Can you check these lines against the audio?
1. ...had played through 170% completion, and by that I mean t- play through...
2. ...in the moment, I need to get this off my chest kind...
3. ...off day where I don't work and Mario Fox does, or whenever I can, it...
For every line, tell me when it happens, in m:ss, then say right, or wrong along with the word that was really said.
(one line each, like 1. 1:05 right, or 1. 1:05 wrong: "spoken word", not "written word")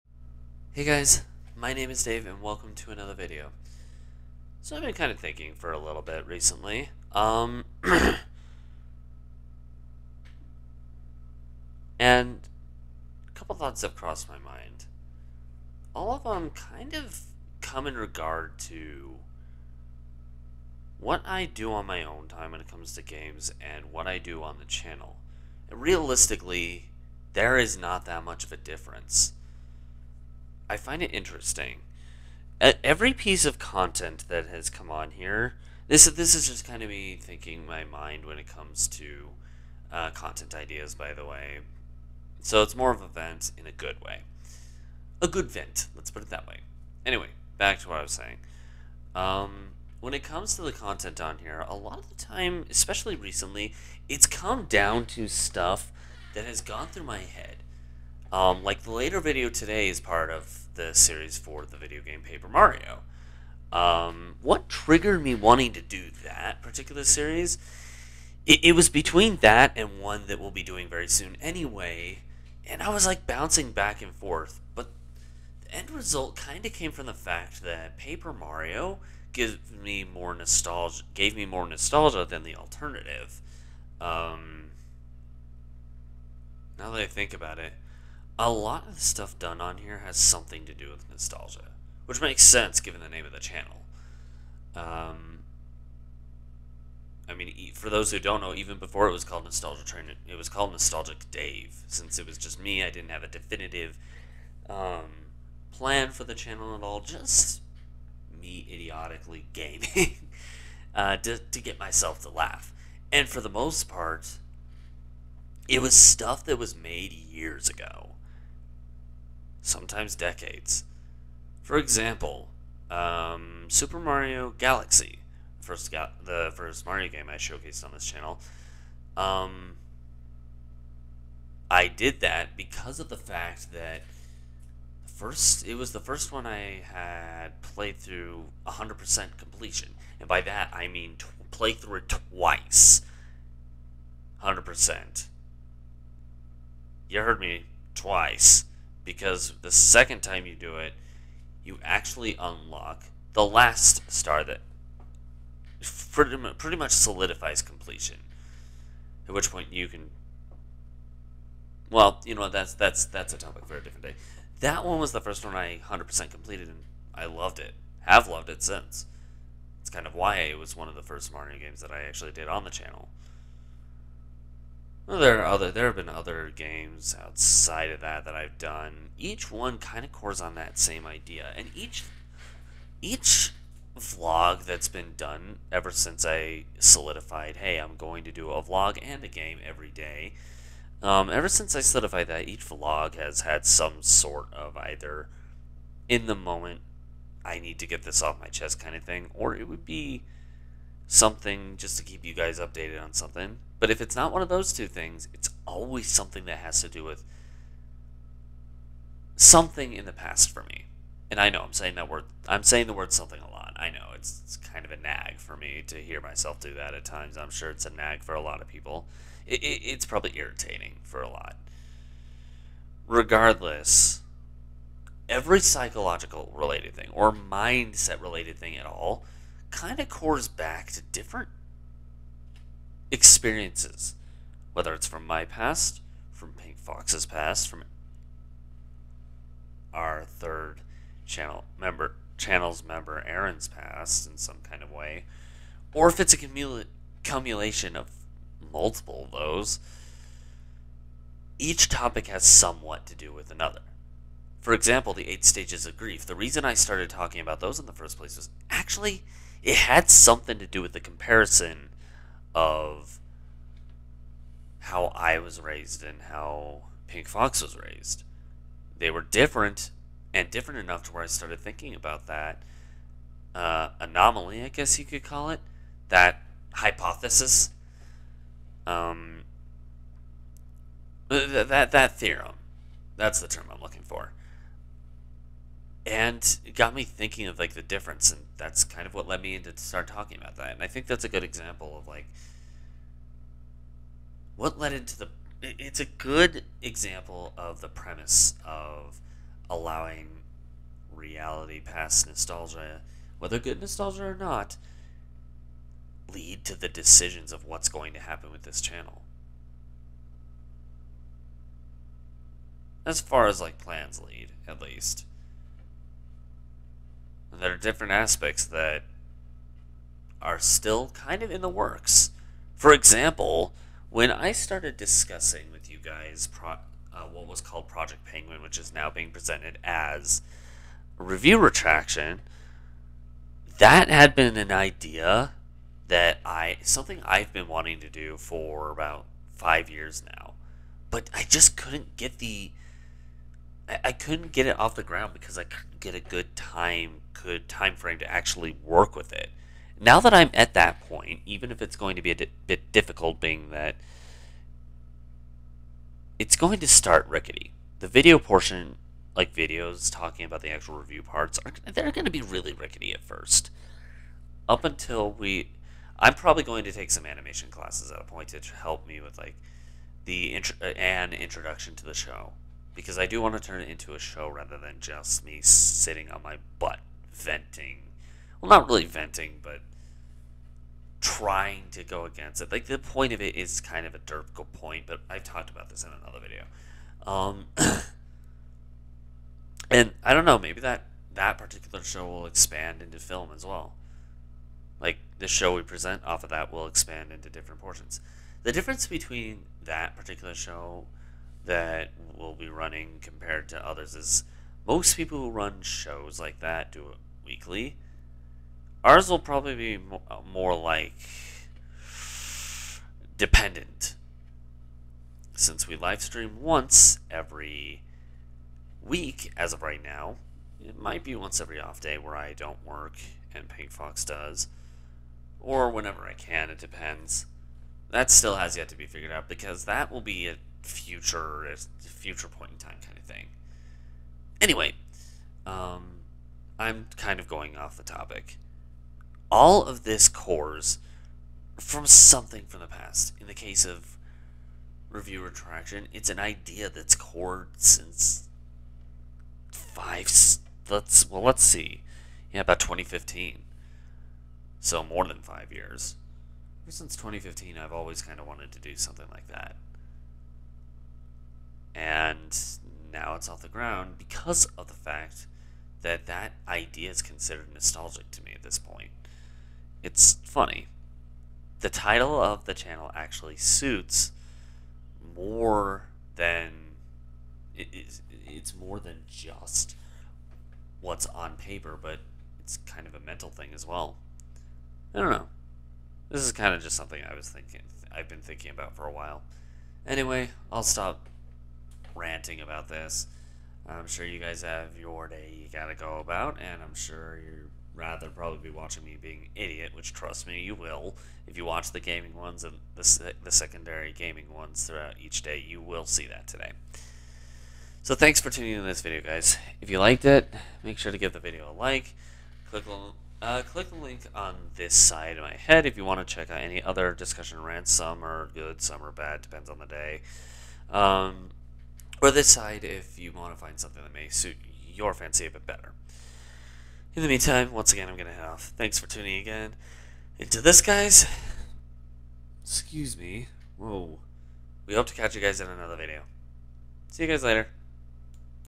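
1. 2:16 wrong: "100", not "170"
2. 3:16 right
3. 7:01 wrong: "Pink", not "Mario".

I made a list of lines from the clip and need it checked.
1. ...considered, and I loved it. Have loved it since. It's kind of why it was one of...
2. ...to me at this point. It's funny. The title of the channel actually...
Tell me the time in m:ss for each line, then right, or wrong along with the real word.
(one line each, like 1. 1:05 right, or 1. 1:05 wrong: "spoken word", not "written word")
1. 2:46 wrong: "completed", not "considered"
2. 7:48 right.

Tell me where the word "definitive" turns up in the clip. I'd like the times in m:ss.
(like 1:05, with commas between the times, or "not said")
1:43.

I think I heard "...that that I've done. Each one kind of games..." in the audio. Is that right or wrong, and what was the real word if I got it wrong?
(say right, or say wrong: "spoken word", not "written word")
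wrong: "cores", not "games".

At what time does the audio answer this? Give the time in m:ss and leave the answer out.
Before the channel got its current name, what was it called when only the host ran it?
1:40.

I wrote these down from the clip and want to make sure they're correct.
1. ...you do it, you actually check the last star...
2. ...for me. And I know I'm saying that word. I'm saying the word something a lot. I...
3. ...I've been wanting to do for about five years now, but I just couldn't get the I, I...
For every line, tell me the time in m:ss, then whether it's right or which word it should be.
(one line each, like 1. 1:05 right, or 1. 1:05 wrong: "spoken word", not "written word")
1. 2:30 wrong: "unlock", not "check"
2. 3:30 right
3. 5:37 right.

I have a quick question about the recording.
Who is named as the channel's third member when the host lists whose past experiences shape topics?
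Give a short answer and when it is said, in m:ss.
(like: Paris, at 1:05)
Aaron, at 4:03.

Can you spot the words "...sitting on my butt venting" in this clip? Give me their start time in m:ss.
6:15.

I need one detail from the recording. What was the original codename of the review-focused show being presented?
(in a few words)
Project Penguin.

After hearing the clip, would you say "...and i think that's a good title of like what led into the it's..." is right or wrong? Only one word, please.
wrong.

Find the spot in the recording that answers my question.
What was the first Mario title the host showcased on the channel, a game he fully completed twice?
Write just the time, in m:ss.
2:03.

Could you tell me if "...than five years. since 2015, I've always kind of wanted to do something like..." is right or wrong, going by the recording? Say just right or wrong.
right.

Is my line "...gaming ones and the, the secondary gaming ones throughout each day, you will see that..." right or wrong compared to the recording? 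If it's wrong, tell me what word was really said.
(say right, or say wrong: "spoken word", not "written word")
right.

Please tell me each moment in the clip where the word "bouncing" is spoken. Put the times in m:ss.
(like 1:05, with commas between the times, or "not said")
1:13.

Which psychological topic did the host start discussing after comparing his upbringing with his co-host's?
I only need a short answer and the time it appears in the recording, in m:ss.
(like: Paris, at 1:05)
the eight stages of grief, at 4:15.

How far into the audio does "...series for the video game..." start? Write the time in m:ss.
1:00.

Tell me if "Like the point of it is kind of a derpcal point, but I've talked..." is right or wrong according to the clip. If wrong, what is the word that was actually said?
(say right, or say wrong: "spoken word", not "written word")
right.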